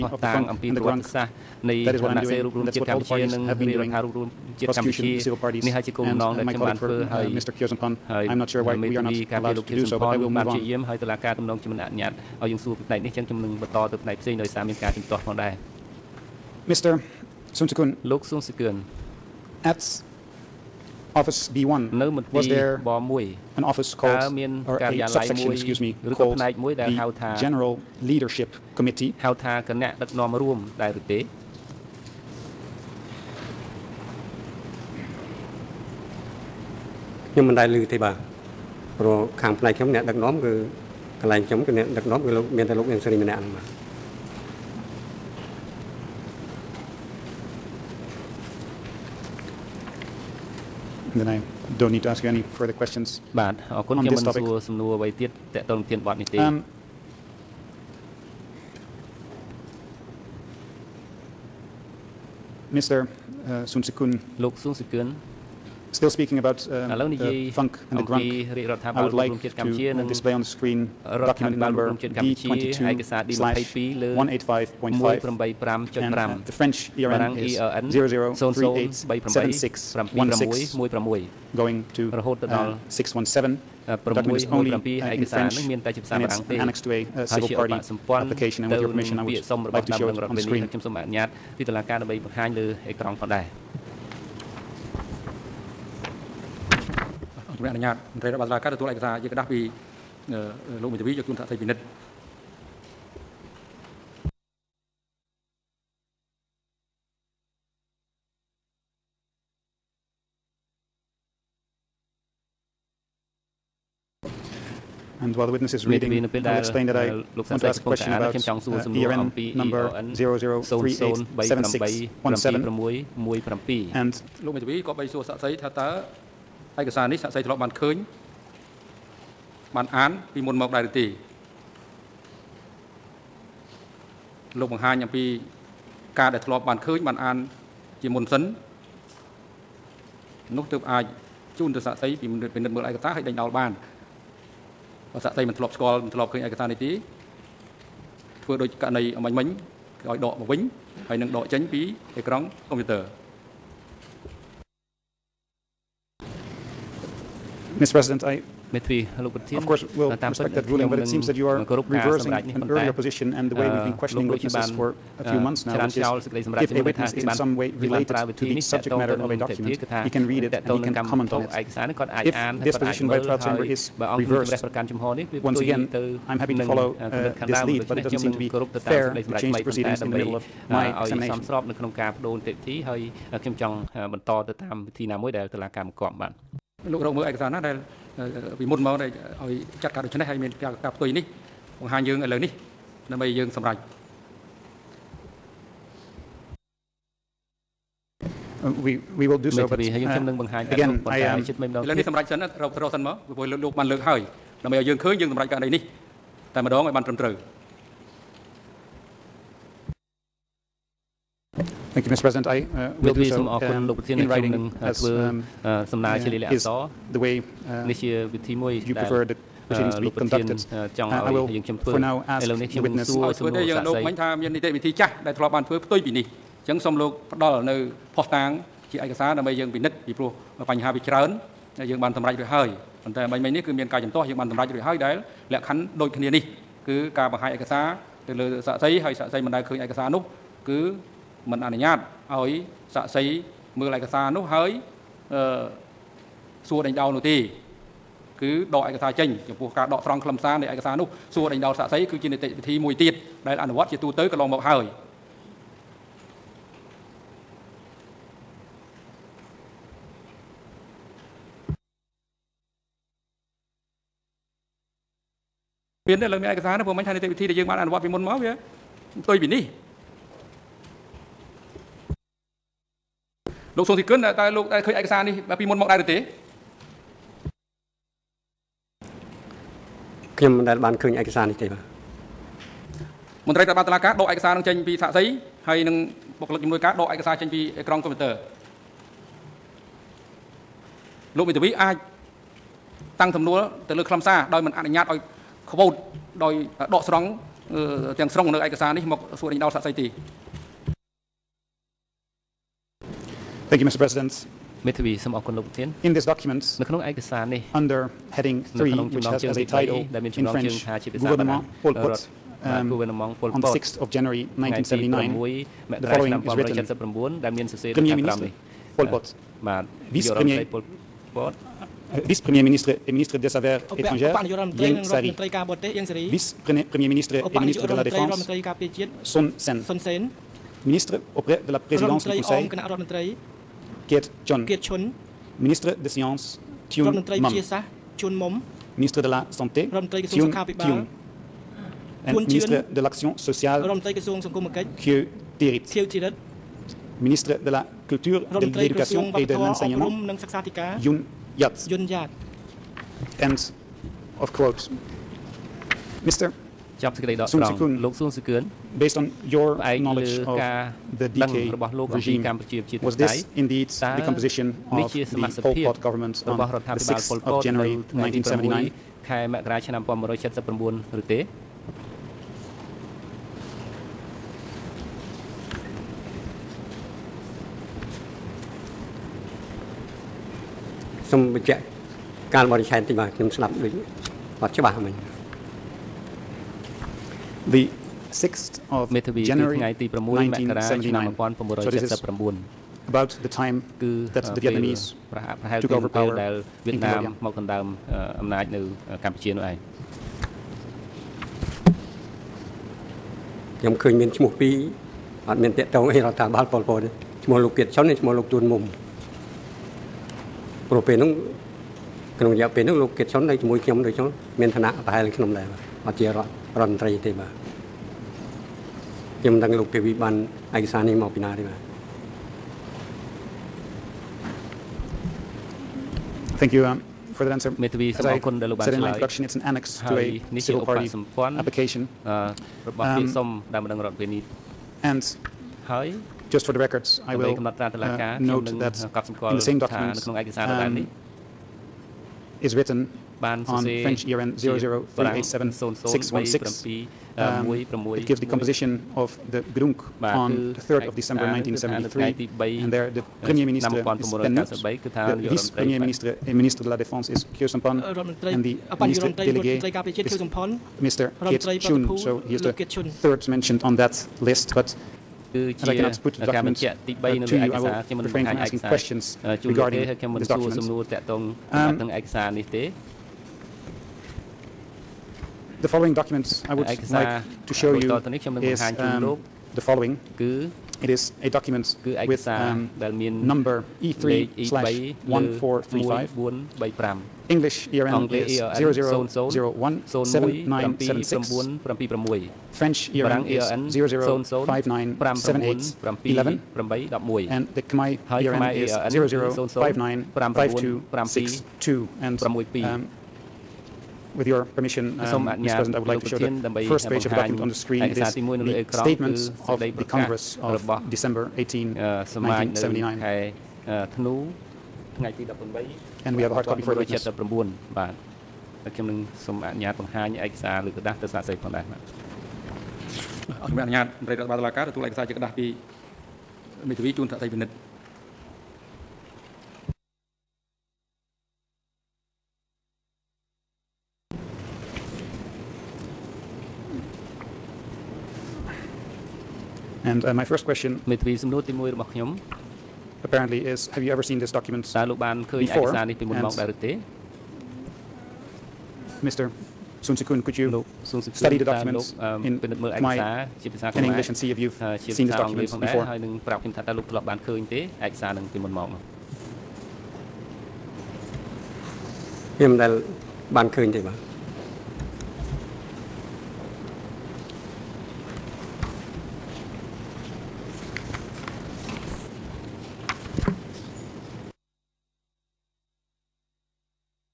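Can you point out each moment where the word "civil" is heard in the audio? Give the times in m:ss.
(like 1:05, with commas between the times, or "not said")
0:04, 7:10.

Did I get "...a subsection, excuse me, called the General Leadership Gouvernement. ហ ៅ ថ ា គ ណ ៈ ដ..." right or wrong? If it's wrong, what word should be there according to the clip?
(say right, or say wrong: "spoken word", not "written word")
wrong: "Committee", not "Gouvernement".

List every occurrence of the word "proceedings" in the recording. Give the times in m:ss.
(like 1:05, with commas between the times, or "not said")
2:59, 3:39.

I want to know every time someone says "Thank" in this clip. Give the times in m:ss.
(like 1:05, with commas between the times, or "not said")
3:31, 5:03, 7:06.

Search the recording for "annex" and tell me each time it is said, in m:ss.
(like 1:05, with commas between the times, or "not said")
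7:09.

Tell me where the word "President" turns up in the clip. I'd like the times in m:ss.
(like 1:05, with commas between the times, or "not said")
2:37, 3:32, 5:04, 8:25.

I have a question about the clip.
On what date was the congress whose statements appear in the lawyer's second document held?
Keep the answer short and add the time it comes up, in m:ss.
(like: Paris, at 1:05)
December 18, 1979, at 8:31.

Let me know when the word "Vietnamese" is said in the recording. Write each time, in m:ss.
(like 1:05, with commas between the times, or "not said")
6:34.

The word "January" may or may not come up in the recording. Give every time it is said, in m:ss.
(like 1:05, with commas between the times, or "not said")
5:14, 6:07, 6:29.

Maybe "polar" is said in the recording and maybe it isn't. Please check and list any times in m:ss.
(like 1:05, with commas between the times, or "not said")
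not said.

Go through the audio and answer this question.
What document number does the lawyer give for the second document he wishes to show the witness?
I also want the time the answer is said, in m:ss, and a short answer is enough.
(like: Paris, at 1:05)
E3/1435, at 8:04.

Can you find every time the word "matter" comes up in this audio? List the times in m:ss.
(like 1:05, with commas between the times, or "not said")
2:48.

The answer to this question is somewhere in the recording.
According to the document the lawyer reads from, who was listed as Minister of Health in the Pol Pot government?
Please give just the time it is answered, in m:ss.
5:38.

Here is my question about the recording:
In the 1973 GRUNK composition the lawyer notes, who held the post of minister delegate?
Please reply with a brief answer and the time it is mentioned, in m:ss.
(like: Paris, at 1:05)
Keat Chhon, at 7:41.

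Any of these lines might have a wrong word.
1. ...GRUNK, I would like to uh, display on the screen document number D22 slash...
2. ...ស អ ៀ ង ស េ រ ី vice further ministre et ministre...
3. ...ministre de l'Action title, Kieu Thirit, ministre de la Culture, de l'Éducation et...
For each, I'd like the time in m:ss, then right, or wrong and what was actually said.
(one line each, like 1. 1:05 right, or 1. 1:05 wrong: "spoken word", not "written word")
1. 1:08 right
2. 5:25 wrong: "premier", not "further"
3. 5:42 wrong: "sociale", not "title".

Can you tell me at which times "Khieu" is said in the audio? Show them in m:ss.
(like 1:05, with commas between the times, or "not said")
0:07, 7:37.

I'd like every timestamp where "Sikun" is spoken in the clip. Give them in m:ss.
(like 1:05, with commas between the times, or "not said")
1:03, 9:10.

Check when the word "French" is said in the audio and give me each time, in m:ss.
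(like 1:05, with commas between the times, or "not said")
1:16, 5:10, 7:23.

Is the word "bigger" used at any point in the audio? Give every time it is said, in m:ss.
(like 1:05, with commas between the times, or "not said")
not said.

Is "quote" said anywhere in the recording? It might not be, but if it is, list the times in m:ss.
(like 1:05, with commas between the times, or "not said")
4:55, 5:54.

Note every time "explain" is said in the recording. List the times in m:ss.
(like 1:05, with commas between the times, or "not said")
1:56.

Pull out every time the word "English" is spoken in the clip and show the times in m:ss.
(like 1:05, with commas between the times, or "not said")
9:14.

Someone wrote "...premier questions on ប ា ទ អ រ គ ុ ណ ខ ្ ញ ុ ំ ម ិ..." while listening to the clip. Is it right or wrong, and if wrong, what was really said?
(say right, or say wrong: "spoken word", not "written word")
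wrong: "further", not "premier".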